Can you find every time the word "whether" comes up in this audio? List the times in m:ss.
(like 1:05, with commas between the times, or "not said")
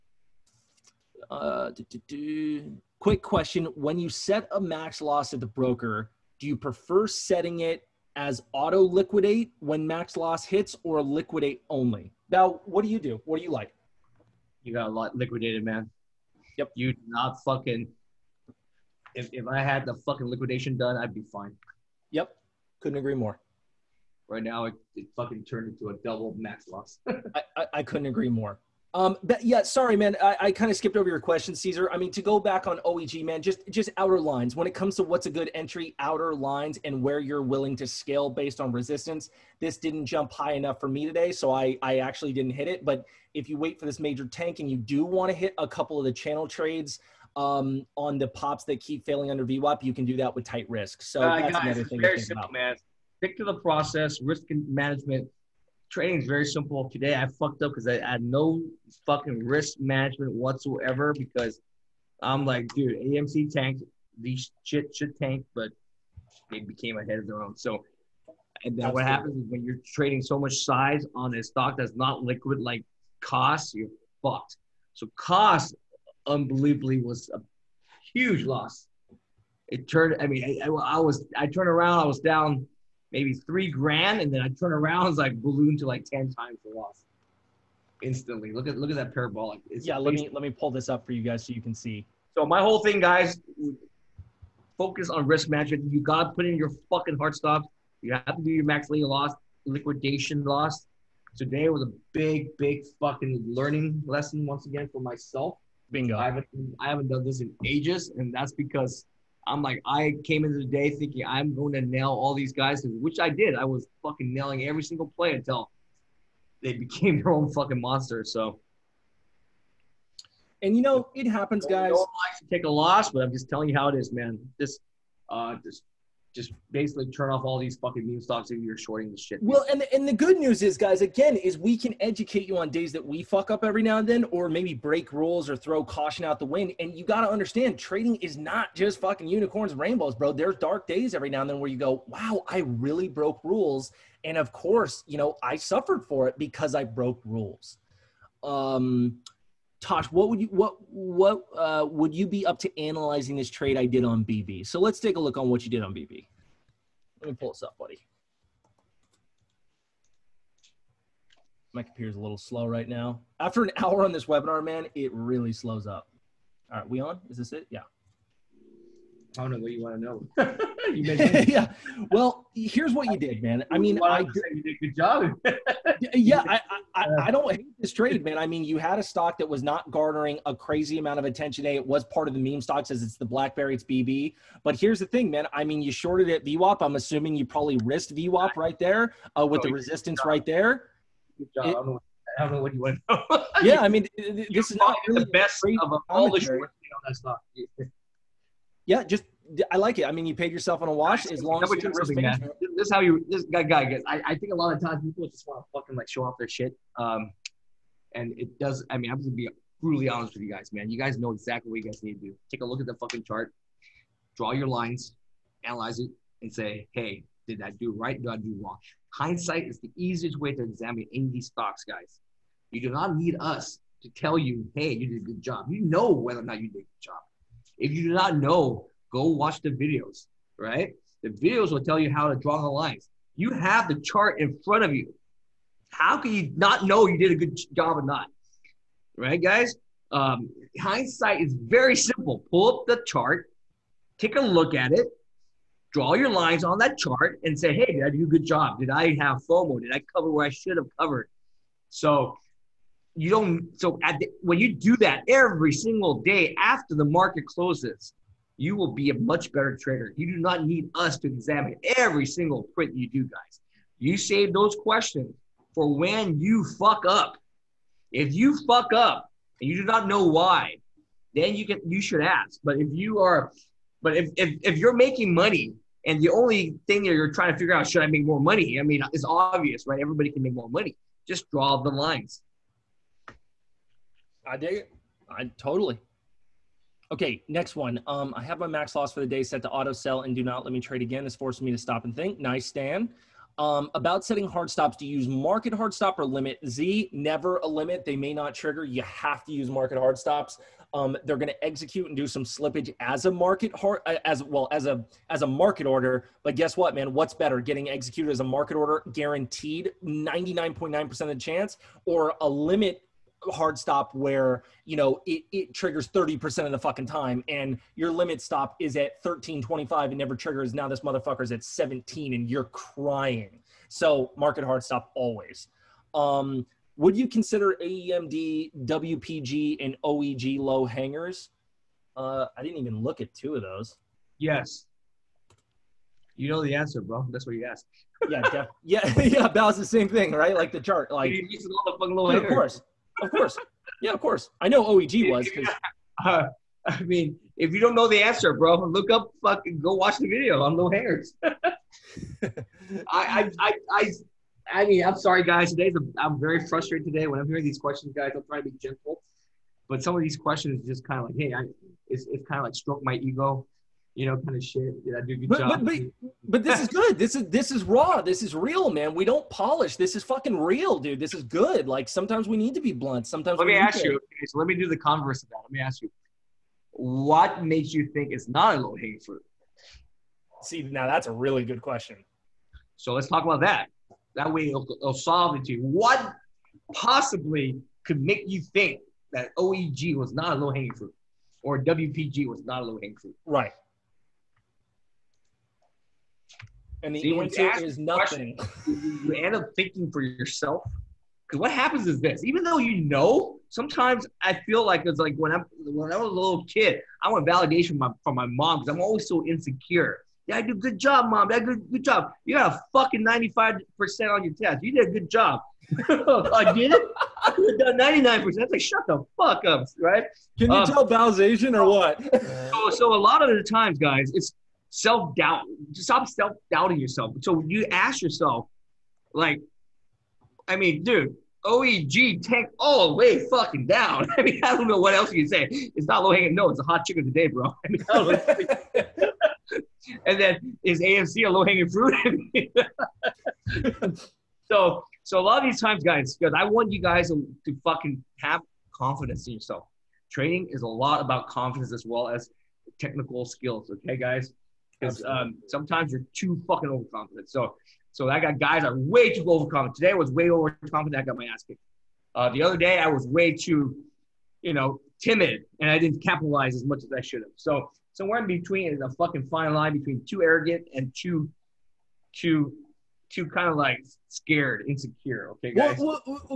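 3:46.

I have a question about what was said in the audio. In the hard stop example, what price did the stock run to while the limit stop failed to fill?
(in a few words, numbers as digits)
17.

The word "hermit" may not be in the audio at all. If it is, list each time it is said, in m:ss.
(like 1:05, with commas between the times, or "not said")
not said.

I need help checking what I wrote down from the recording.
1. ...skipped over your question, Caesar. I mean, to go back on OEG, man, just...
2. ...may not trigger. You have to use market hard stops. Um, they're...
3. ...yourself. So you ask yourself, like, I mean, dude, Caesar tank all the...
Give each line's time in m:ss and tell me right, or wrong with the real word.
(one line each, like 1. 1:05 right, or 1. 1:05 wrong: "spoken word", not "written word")
1. 0:30 right
2. 4:58 right
3. 7:06 wrong: "OEG", not "Caesar".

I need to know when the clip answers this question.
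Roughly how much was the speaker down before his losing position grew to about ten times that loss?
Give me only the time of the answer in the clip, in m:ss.
1:23.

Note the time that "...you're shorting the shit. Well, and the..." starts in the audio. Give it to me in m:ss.
2:08.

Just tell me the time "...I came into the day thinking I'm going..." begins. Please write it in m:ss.
1:49.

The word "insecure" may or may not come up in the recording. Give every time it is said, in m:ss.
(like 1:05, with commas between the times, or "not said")
6:49, 7:54.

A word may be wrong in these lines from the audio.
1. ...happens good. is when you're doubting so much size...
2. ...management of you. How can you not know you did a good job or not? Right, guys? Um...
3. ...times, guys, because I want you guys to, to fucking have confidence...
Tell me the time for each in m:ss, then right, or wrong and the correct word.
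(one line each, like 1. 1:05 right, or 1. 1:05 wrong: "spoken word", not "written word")
1. 1:09 wrong: "trading", not "doubting"
2. 3:54 wrong: "front", not "management"
3. 7:25 right.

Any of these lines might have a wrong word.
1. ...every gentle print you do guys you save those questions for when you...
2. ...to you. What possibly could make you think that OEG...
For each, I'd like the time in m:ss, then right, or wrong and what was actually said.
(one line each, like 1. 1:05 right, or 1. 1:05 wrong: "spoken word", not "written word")
1. 4:21 wrong: "single", not "gentle"
2. 6:25 right.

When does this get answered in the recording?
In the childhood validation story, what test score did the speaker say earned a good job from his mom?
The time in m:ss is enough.
6:53.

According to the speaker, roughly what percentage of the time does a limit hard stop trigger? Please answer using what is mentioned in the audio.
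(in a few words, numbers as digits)
30%.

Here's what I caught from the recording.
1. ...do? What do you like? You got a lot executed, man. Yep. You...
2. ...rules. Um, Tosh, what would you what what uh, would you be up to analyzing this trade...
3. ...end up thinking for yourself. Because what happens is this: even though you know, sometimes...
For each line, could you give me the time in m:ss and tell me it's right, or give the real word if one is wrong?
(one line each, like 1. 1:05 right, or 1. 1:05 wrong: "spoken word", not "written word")
1. 0:12 wrong: "liquidated", not "executed"
2. 2:27 right
3. 6:39 right.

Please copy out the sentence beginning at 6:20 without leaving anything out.
See, now that's a really good question.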